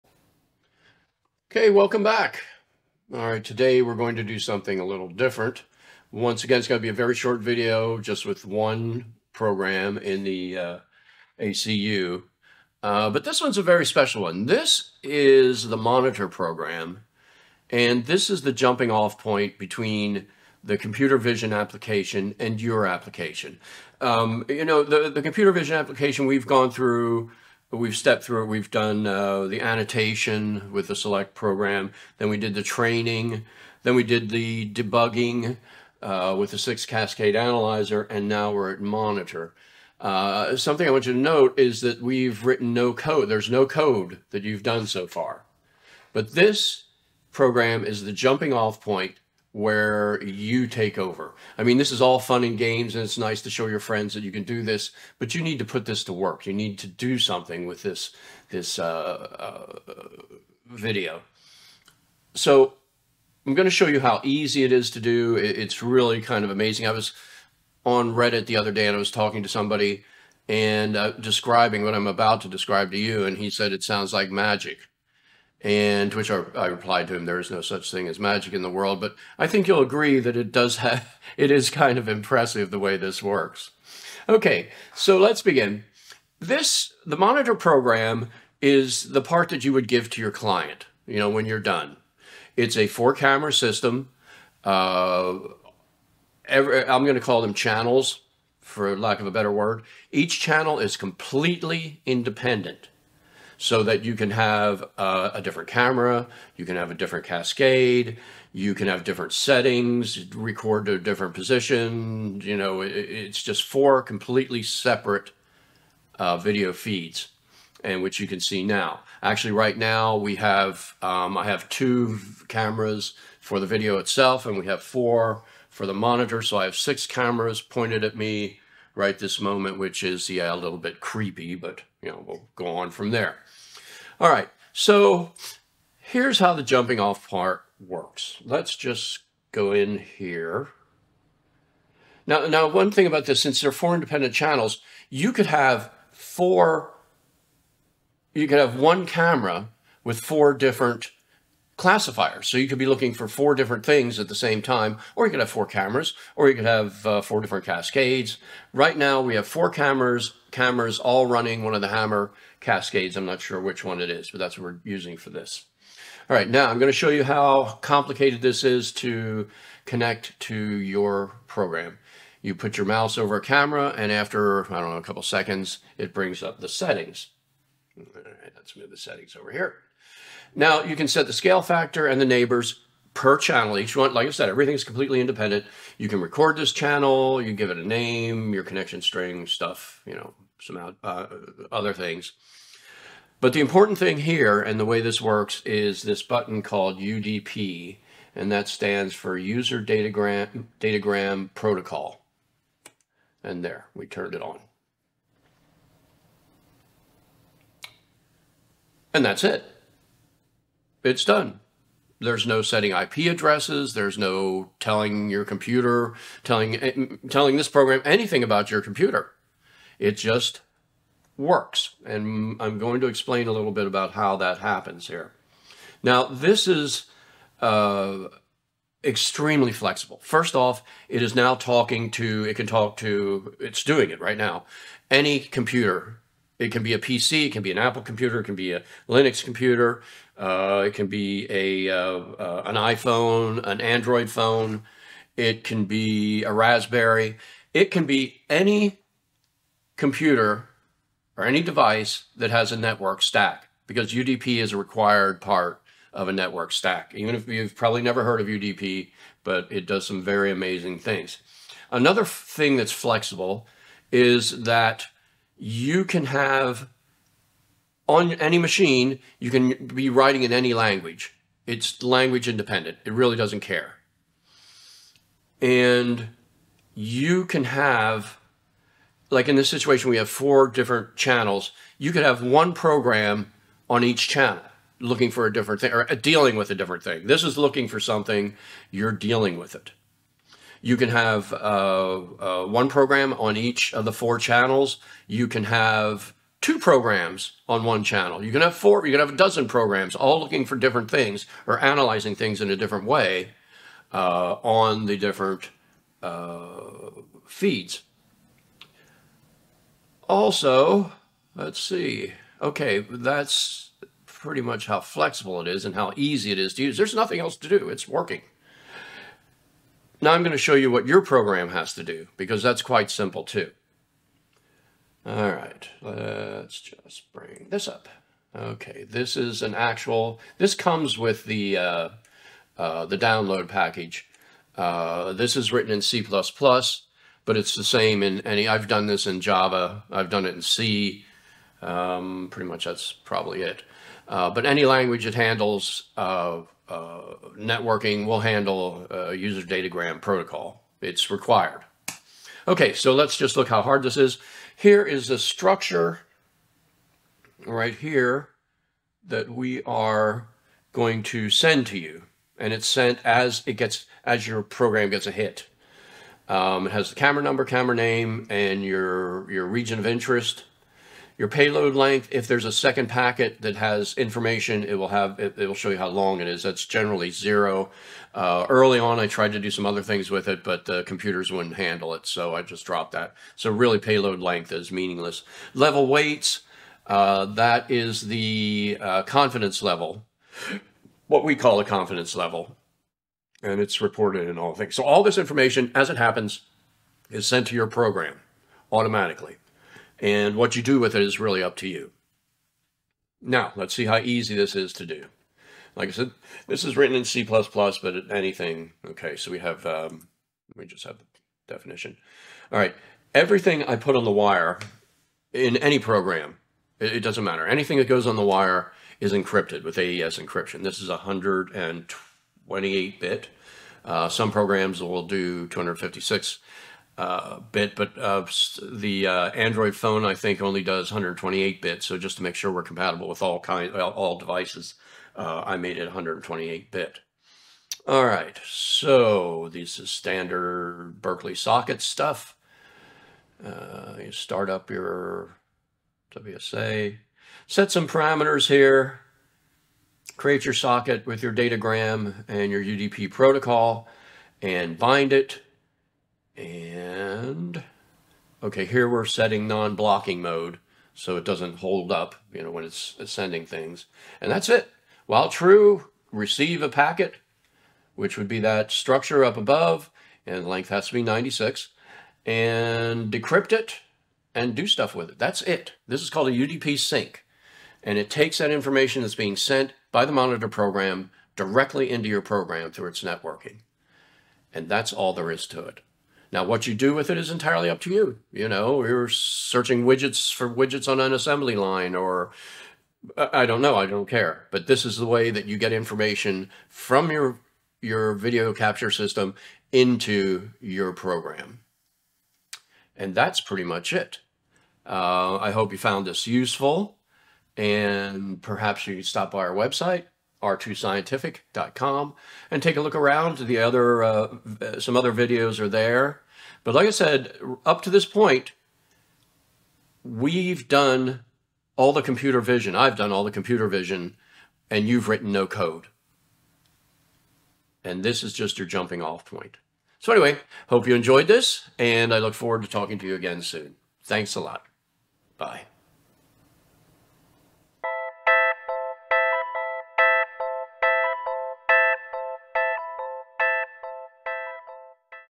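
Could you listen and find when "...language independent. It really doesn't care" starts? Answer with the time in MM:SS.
04:32.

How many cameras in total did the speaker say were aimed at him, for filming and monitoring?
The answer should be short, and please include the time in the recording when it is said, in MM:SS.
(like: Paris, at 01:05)
6, at 02:06.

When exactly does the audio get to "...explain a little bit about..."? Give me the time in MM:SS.
03:43.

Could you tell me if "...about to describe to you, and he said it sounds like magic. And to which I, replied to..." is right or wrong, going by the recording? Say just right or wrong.
right.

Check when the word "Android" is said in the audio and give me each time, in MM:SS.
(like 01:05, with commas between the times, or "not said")
04:03, 07:09.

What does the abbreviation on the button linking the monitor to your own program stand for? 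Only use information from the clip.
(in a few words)
User Datagram Protocol.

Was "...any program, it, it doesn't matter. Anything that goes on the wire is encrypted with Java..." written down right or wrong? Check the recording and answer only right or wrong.
wrong.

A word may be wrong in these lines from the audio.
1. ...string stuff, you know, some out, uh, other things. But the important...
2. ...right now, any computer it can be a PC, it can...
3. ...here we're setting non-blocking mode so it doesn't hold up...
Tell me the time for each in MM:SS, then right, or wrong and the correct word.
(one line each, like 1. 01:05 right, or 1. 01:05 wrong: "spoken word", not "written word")
1. 03:09 right
2. 03:54 right
3. 07:38 right.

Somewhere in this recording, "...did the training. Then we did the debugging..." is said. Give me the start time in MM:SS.
00:32.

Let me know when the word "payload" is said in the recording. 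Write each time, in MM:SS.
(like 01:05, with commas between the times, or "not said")
06:11, 06:23.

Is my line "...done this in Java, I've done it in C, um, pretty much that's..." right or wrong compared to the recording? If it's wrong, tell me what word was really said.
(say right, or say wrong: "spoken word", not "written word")
right.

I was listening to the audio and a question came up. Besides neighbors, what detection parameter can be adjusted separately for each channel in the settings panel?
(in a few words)
Scale factor.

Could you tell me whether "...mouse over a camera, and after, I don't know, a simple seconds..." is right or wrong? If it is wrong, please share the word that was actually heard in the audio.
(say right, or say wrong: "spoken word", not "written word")
wrong: "couple", not "simple".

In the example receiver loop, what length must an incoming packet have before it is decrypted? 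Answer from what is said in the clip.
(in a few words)
96.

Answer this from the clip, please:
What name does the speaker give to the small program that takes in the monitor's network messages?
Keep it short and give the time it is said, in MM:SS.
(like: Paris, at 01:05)
UDP sink, at 07:56.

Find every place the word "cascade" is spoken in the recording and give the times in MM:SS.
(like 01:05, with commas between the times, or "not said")
00:36, 01:47, 02:37, 02:42.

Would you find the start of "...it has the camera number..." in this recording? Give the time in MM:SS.
06:06.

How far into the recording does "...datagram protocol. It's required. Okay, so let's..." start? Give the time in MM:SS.
05:49.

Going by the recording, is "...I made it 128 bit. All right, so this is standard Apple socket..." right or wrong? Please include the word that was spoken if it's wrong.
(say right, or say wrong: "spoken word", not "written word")
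wrong: "Berkeley", not "Apple".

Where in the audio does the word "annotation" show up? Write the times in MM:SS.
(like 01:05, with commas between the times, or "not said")
00:29.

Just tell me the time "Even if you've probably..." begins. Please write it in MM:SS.
04:17.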